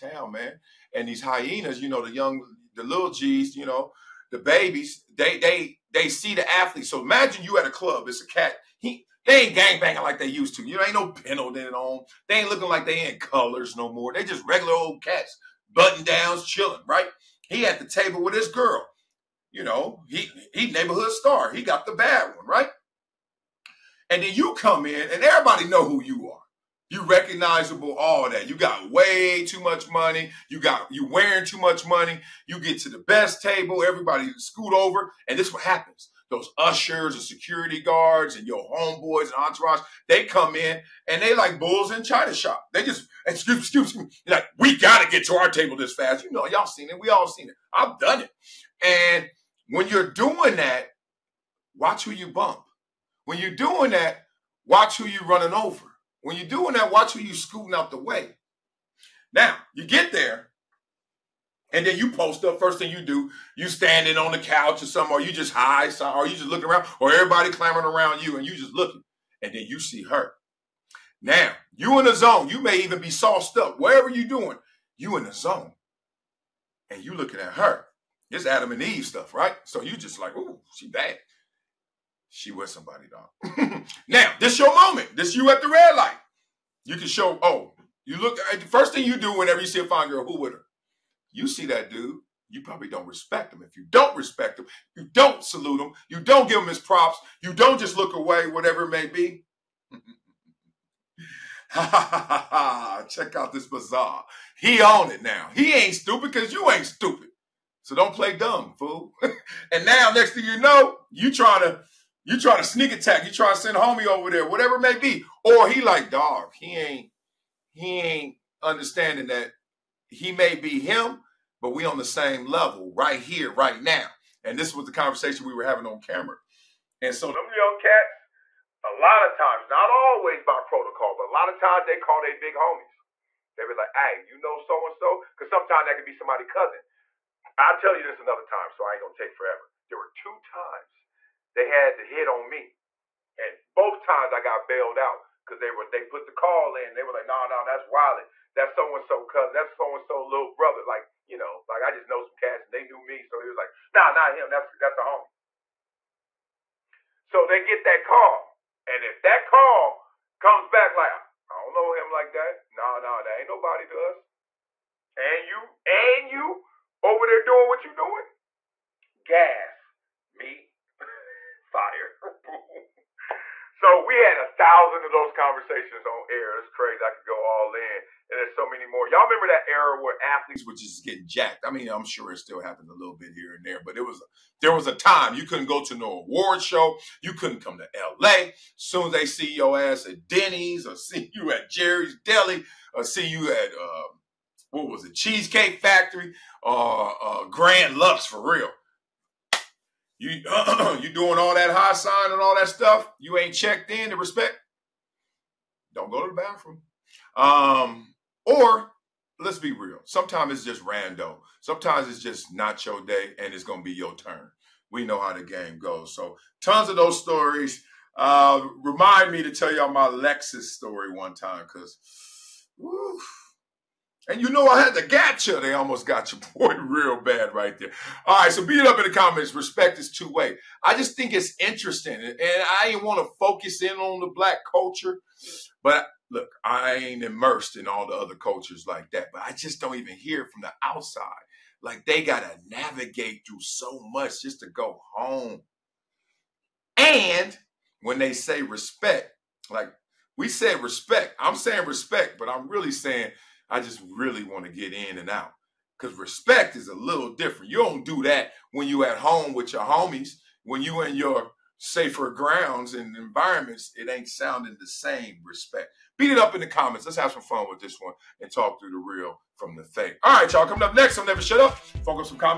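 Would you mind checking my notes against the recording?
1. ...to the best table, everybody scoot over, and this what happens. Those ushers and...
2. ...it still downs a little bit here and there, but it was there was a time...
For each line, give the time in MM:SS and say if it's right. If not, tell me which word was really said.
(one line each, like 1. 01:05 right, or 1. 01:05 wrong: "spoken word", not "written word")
1. 00:32 right
2. 03:02 wrong: "happens", not "downs".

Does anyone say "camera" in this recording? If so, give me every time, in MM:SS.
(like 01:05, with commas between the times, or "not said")
02:06.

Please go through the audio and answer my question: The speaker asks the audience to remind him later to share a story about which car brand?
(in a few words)
Lexus.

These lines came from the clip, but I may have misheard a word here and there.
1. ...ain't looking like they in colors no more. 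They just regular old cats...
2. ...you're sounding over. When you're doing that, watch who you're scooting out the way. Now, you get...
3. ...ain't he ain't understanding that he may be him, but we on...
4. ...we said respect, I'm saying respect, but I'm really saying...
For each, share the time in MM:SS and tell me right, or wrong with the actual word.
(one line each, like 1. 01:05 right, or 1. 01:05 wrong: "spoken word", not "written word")
1. 00:12 right
2. 00:55 wrong: "running", not "sounding"
3. 01:56 right
4. 04:10 right.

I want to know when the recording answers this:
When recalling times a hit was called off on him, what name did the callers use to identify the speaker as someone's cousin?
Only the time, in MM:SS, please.
02:27.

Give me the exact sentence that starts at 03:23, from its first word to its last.
You ain't checked in to respect.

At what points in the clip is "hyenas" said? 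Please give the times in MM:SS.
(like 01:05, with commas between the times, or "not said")
00:01.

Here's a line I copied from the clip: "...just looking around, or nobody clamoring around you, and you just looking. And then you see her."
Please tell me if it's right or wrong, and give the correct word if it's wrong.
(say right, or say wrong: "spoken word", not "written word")
wrong: "everybody", not "nobody".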